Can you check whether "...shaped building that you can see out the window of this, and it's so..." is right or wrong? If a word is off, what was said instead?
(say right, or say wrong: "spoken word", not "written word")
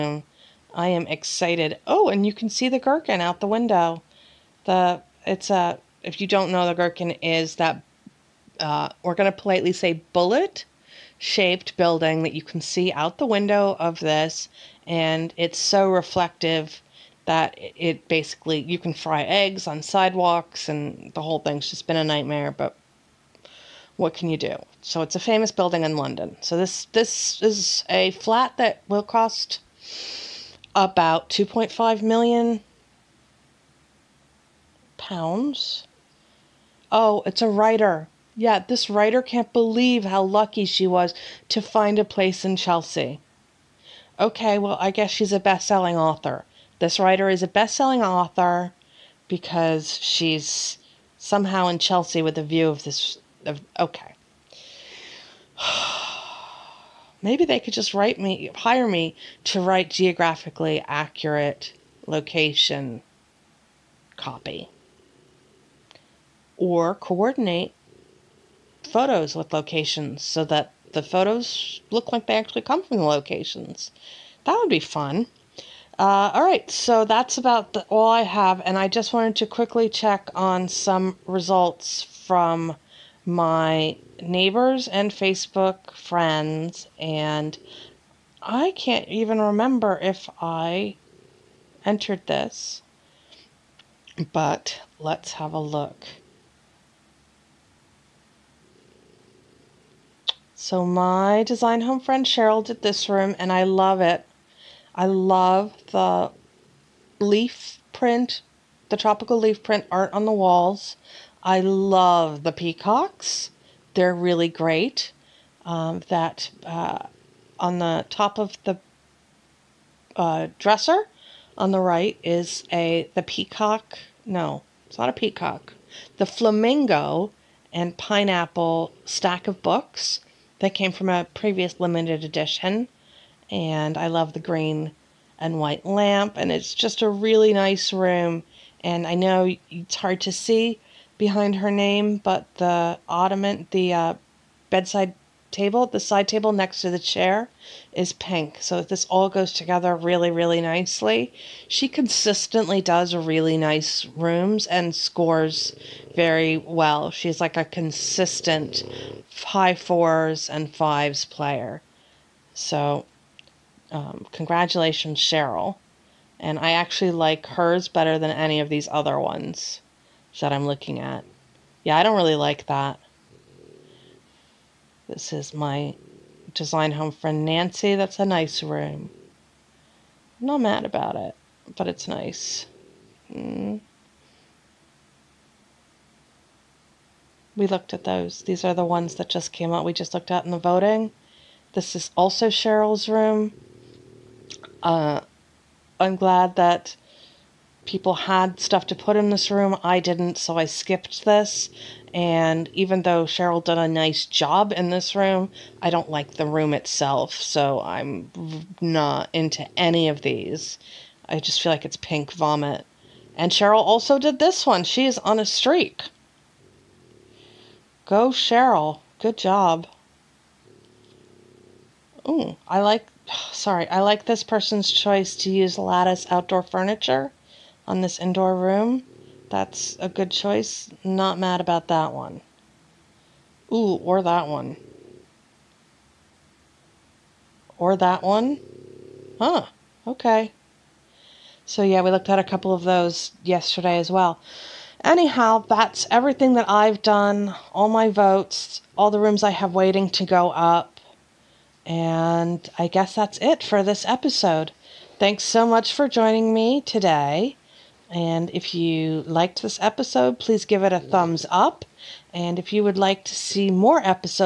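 right.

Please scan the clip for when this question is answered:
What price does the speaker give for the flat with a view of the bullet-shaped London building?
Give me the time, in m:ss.
0:31.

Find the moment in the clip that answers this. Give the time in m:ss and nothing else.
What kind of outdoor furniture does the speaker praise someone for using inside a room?
3:45.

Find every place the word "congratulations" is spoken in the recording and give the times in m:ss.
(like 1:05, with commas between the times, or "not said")
2:44.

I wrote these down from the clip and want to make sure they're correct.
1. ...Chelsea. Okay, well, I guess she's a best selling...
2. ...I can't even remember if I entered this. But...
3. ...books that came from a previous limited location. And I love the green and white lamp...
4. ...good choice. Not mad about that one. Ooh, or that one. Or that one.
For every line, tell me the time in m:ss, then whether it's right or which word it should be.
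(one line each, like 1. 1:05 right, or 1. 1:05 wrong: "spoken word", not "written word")
1. 0:42 right
2. 1:28 right
3. 2:09 wrong: "edition", not "location"
4. 3:50 right.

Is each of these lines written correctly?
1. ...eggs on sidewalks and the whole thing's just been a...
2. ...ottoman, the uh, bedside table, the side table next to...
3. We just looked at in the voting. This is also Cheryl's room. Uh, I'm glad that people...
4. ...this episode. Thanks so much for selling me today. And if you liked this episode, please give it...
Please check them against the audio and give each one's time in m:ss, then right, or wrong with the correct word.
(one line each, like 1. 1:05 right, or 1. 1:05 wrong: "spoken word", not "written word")
1. 0:19 right
2. 2:23 right
3. 3:09 right
4. 4:13 wrong: "joining", not "selling".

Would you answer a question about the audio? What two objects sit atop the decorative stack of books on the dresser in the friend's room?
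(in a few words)
flamingo and pineapple.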